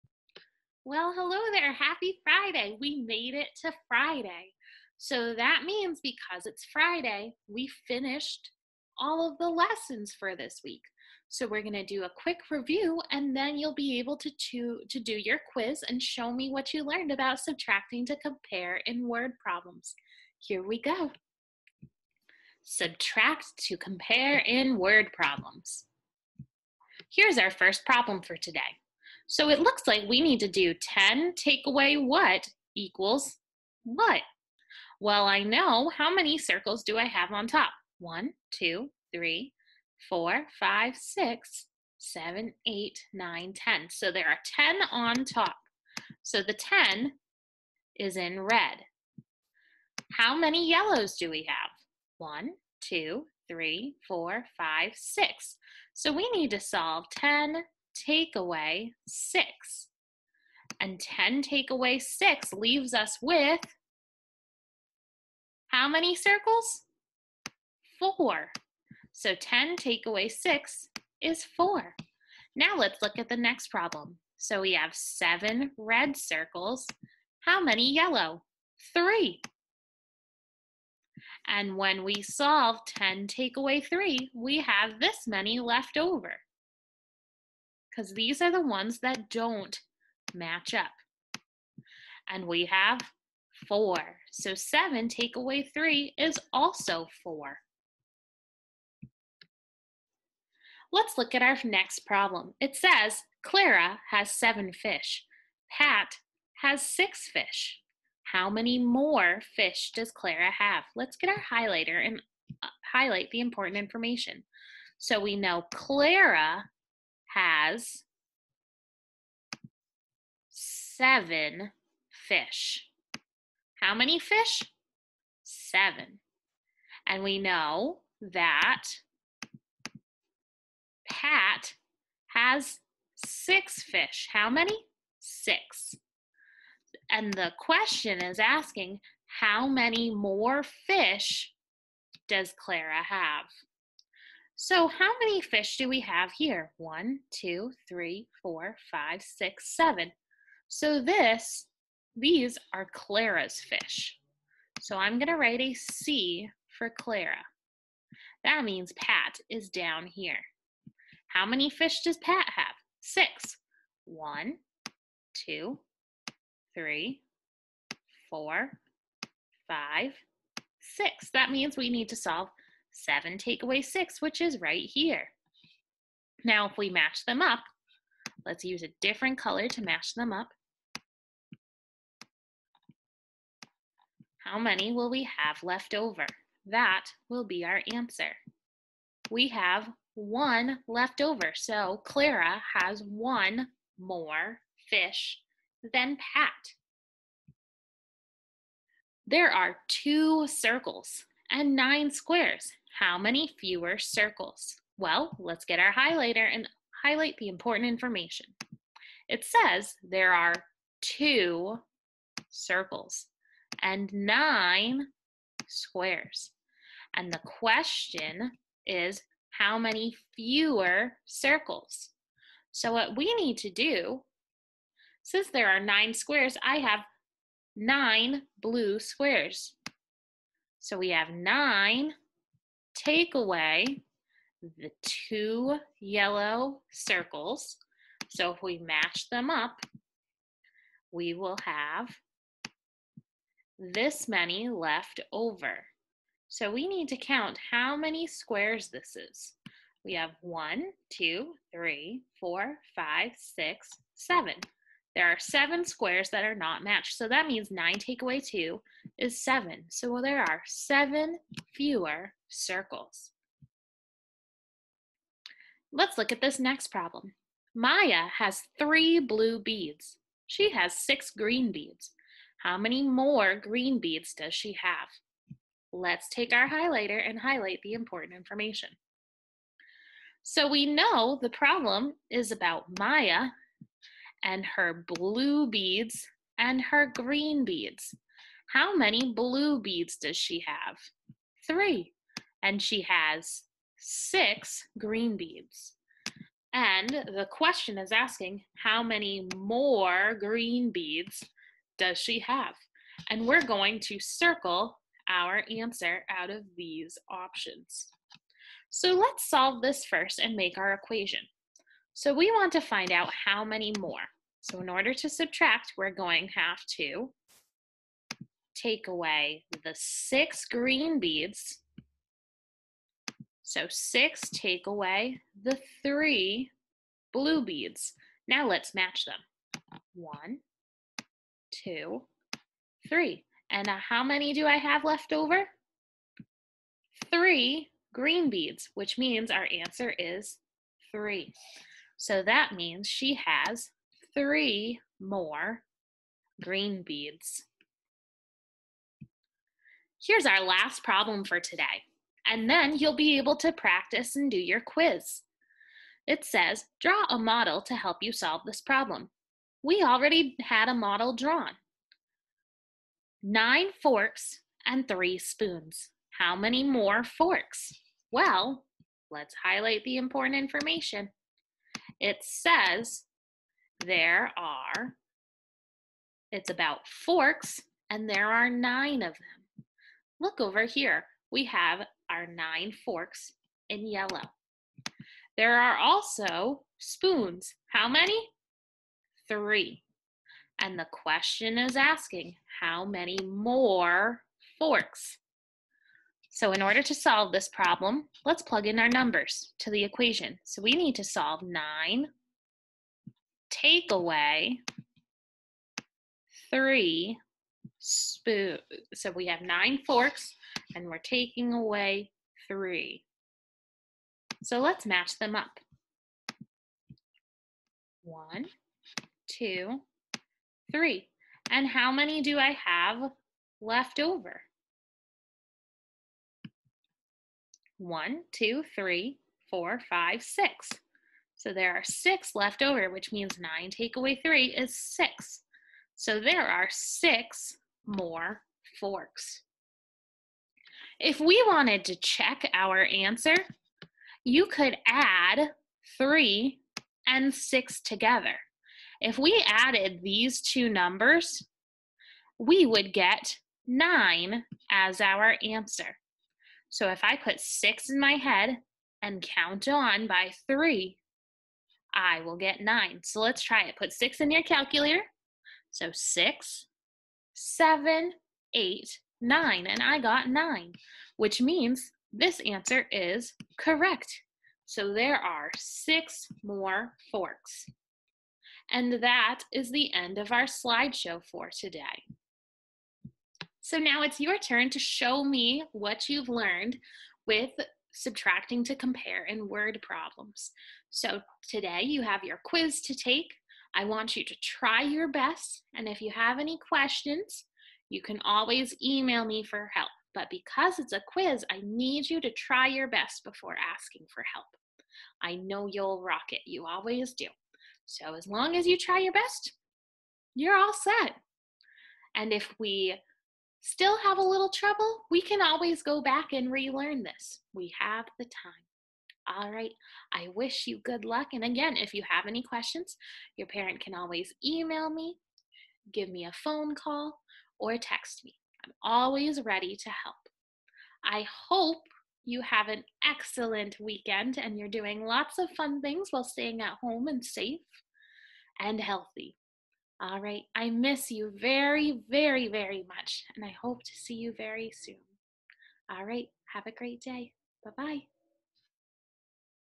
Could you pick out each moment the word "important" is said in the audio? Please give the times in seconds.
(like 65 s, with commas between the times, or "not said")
113 s, 207 s, 277 s, 370 s.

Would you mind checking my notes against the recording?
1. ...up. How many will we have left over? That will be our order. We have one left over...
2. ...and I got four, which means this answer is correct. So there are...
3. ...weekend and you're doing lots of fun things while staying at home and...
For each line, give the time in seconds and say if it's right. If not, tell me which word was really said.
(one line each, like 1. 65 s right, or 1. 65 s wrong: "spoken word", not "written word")
1. 180 s wrong: "answer", not "order"
2. 469 s wrong: "nine", not "four"
3. 533 s right.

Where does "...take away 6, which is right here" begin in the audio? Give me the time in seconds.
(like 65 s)
173 s.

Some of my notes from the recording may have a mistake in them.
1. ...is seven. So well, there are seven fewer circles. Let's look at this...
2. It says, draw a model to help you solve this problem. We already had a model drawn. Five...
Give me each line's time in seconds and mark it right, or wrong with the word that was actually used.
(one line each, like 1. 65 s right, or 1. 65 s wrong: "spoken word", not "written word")
1. 259 s right
2. 356 s wrong: "Nine", not "Five".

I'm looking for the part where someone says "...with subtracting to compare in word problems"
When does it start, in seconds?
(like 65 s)
487 s.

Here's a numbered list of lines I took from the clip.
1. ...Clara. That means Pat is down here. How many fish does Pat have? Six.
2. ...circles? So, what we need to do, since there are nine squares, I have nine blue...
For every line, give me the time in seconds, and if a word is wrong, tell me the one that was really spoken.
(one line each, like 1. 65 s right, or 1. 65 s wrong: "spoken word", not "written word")
1. 156 s right
2. 221 s right.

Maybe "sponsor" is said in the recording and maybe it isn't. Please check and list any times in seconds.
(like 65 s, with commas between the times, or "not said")
not said.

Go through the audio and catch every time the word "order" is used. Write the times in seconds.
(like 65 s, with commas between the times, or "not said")
314 s, 396 s.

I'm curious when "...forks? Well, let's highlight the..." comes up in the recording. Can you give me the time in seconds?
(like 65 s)
367 s.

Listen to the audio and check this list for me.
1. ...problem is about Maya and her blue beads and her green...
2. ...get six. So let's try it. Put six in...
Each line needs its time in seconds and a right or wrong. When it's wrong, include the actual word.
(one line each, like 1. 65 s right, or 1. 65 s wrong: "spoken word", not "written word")
1. 281 s right
2. 462 s wrong: "nine", not "six".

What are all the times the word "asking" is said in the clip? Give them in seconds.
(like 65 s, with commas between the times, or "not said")
138 s, 298 s, 391 s, 503 s.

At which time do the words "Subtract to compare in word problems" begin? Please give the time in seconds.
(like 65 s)
22 s.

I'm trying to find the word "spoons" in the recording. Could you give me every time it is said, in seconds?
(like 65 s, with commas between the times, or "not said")
365 s, 386 s, 408 s.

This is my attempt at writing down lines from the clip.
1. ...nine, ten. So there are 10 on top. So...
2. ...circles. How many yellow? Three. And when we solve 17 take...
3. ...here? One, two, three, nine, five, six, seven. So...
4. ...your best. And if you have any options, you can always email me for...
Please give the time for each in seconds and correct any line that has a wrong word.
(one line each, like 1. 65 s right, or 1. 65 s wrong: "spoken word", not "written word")
1. 43 s right
2. 76 s wrong: "10", not "17"
3. 146 s wrong: "four", not "nine"
4. 495 s wrong: "questions", not "options".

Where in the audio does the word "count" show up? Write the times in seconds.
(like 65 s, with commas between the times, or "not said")
247 s, 459 s.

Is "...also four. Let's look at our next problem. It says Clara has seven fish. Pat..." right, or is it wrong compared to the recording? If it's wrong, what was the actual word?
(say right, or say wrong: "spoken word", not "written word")
right.